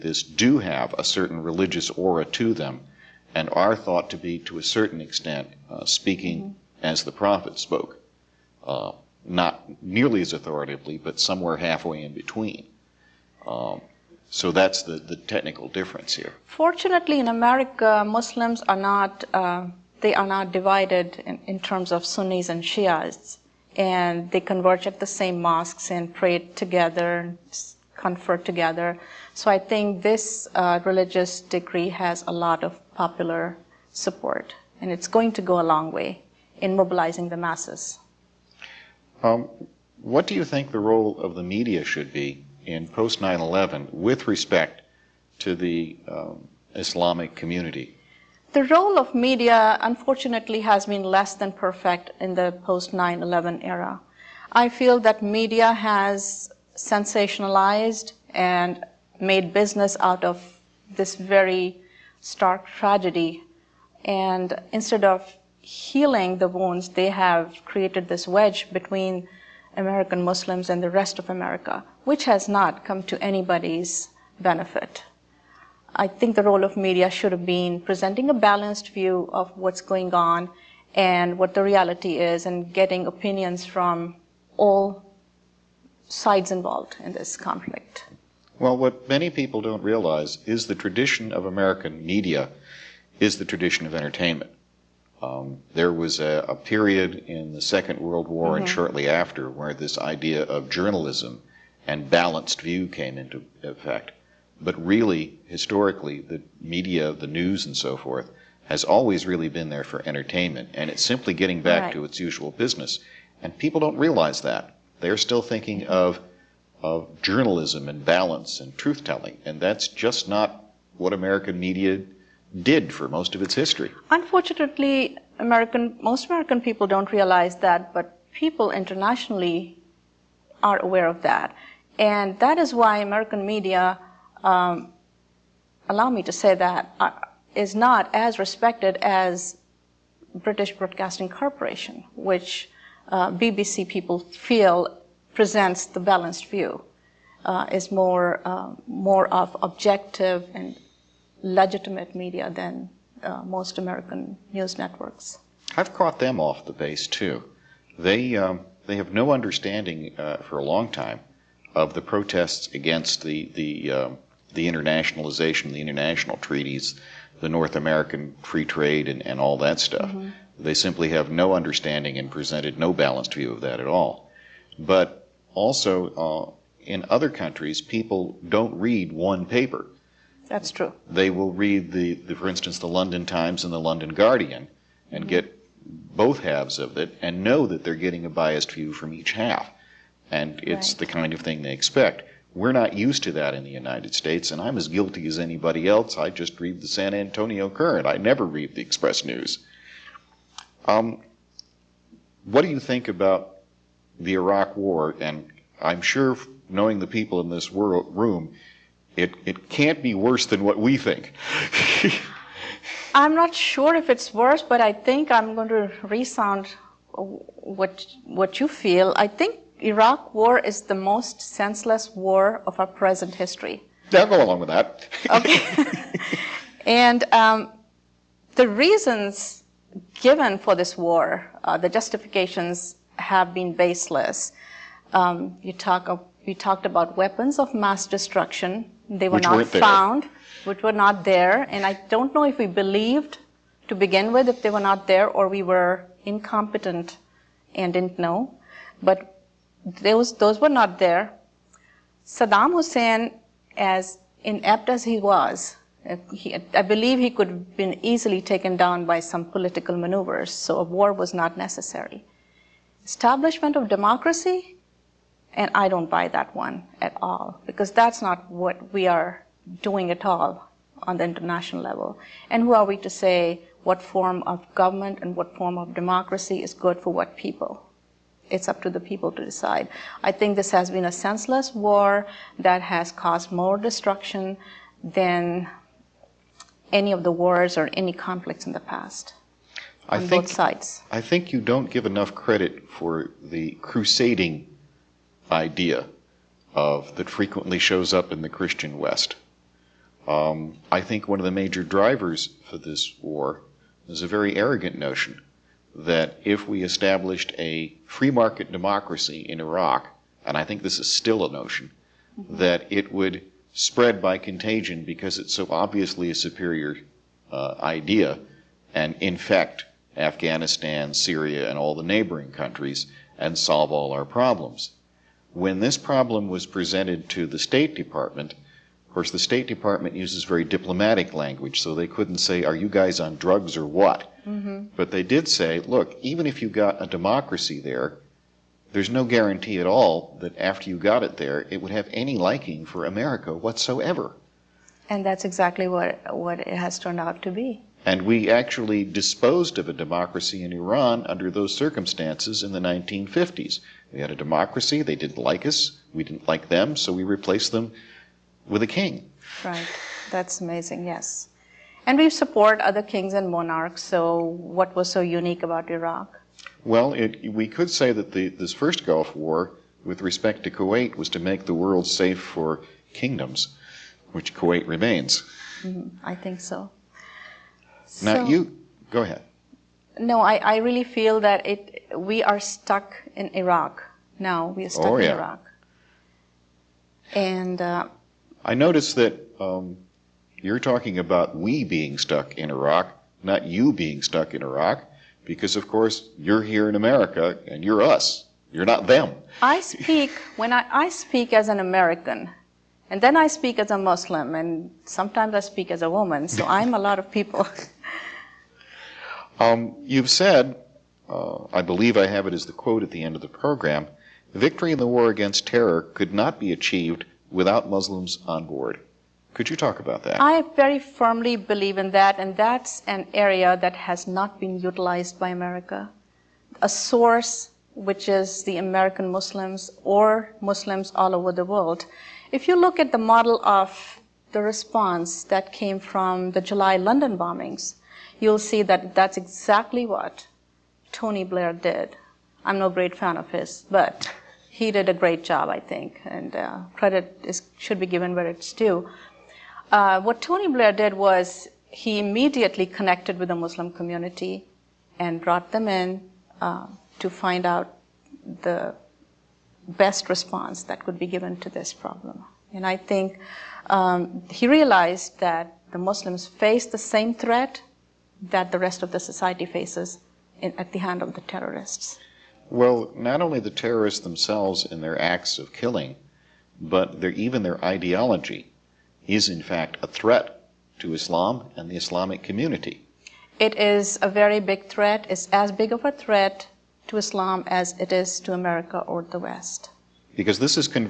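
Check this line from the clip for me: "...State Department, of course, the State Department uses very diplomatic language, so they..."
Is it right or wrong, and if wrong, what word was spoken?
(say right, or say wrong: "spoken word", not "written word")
right.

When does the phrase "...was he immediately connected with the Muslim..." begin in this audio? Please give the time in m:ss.
7:31.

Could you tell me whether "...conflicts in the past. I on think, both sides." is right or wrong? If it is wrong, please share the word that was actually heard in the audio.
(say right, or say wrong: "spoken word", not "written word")
right.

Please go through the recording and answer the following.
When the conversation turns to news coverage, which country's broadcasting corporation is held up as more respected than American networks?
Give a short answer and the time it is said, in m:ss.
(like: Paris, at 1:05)
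British, at 2:20.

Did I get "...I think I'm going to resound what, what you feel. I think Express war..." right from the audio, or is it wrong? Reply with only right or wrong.
wrong.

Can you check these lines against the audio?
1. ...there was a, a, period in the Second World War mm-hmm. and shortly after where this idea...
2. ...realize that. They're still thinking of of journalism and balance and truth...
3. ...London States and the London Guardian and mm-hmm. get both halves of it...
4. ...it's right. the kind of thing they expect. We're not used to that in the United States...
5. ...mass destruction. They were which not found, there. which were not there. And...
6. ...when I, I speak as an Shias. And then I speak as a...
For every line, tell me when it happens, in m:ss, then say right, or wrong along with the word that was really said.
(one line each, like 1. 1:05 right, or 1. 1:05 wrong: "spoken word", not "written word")
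1. 1:35 right
2. 1:53 right
3. 3:02 wrong: "Times", not "States"
4. 3:10 right
5. 3:57 right
6. 6:40 wrong: "American", not "Shias".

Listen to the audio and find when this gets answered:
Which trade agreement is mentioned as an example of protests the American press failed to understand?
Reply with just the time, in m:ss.
2:47.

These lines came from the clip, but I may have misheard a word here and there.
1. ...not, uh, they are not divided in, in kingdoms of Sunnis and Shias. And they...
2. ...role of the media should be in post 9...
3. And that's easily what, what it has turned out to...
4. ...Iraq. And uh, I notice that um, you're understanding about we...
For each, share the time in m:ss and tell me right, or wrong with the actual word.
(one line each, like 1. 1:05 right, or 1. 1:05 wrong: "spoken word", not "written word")
1. 0:18 wrong: "terms", not "kingdoms"
2. 0:40 right
3. 5:45 wrong: "exactly", not "easily"
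4. 6:25 wrong: "talking", not "understanding".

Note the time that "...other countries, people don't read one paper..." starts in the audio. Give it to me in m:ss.
2:57.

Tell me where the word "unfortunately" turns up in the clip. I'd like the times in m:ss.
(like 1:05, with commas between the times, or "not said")
0:49, 2:04.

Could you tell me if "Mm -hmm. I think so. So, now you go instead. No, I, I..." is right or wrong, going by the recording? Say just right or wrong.
wrong.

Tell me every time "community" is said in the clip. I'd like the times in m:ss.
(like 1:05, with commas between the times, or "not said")
0:47, 7:33, 8:02.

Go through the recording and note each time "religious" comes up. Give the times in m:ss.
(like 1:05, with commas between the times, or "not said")
0:01, 0:30.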